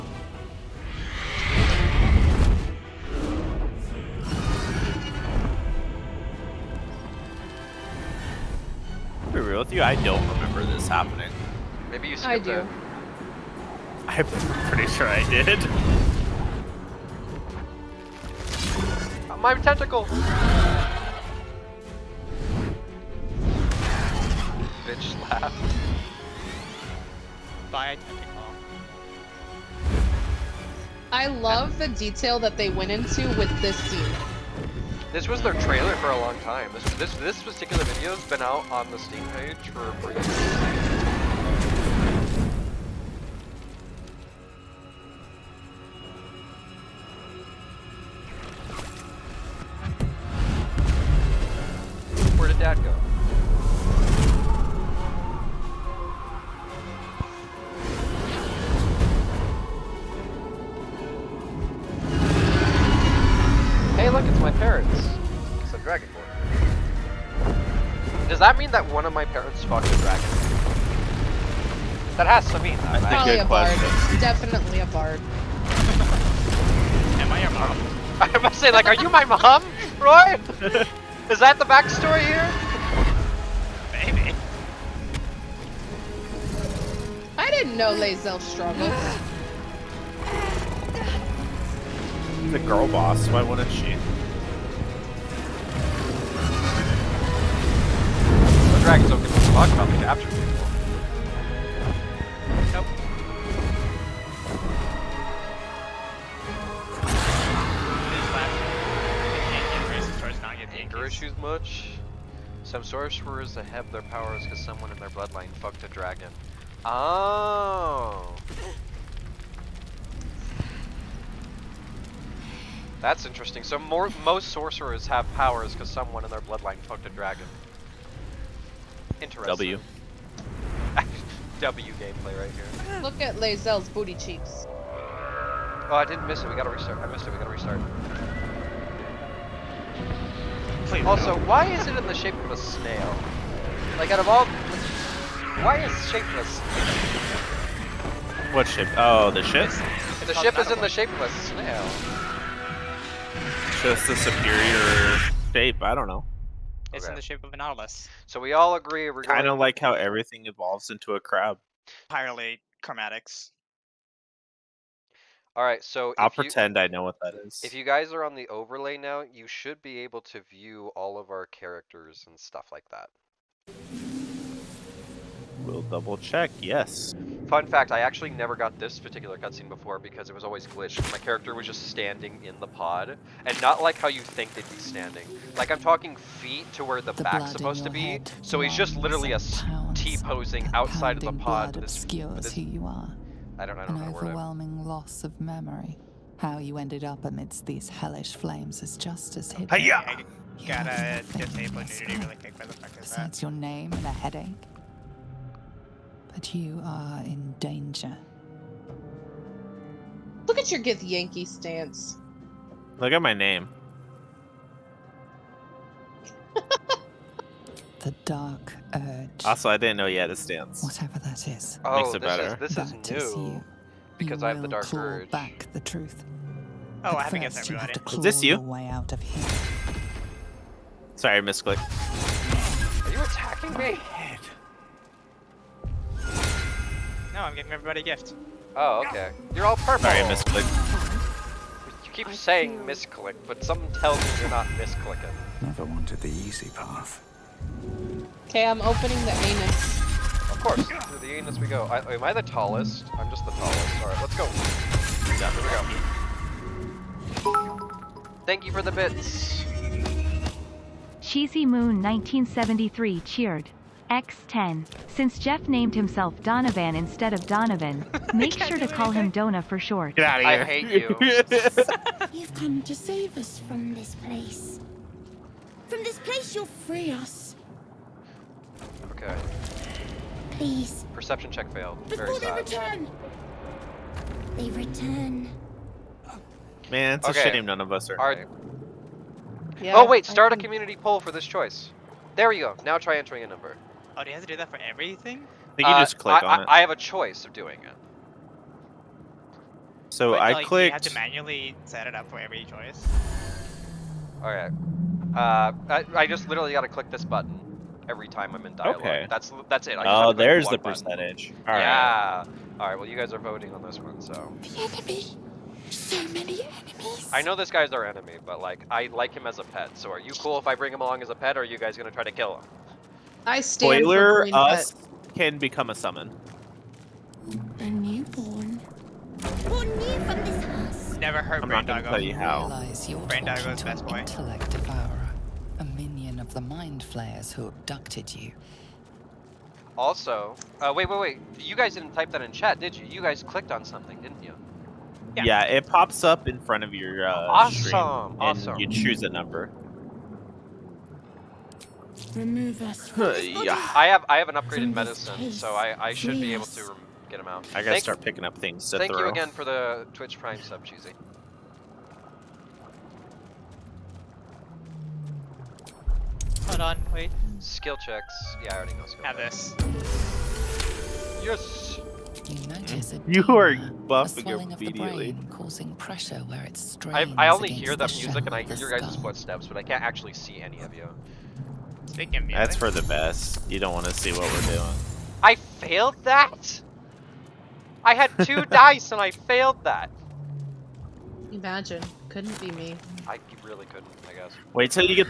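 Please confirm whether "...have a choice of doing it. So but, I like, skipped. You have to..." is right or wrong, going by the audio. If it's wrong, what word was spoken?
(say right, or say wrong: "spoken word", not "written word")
wrong: "clicked", not "skipped".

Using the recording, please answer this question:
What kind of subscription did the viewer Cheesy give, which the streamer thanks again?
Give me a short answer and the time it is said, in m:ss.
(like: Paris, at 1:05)
Twitch Prime sub, at 6:00.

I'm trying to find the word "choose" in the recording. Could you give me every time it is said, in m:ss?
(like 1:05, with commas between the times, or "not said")
5:48.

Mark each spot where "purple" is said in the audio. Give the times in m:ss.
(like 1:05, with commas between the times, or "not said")
3:59.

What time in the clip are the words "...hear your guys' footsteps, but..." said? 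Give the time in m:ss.
6:18.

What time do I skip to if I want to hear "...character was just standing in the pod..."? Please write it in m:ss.
3:01.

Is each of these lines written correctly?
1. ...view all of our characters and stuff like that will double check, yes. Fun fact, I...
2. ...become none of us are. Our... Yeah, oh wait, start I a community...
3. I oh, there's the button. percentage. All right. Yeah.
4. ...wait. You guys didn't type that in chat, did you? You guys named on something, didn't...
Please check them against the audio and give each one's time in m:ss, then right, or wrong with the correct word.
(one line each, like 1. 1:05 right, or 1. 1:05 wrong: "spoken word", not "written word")
1. 2:50 right
2. 4:47 wrong: "shame", not "become"
3. 5:09 right
4. 5:41 wrong: "clicked", not "named".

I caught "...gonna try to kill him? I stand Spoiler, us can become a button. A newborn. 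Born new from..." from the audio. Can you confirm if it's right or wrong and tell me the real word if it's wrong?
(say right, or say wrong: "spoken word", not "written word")
wrong: "summon", not "button".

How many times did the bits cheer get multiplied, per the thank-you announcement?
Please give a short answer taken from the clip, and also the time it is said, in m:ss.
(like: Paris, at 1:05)
10, at 4:24.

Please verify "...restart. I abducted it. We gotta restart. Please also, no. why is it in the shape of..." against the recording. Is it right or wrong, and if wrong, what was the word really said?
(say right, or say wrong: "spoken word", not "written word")
wrong: "missed", not "abducted".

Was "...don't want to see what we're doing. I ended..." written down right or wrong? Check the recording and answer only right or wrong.
wrong.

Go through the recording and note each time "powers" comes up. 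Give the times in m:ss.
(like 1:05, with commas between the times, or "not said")
1:54, 2:05.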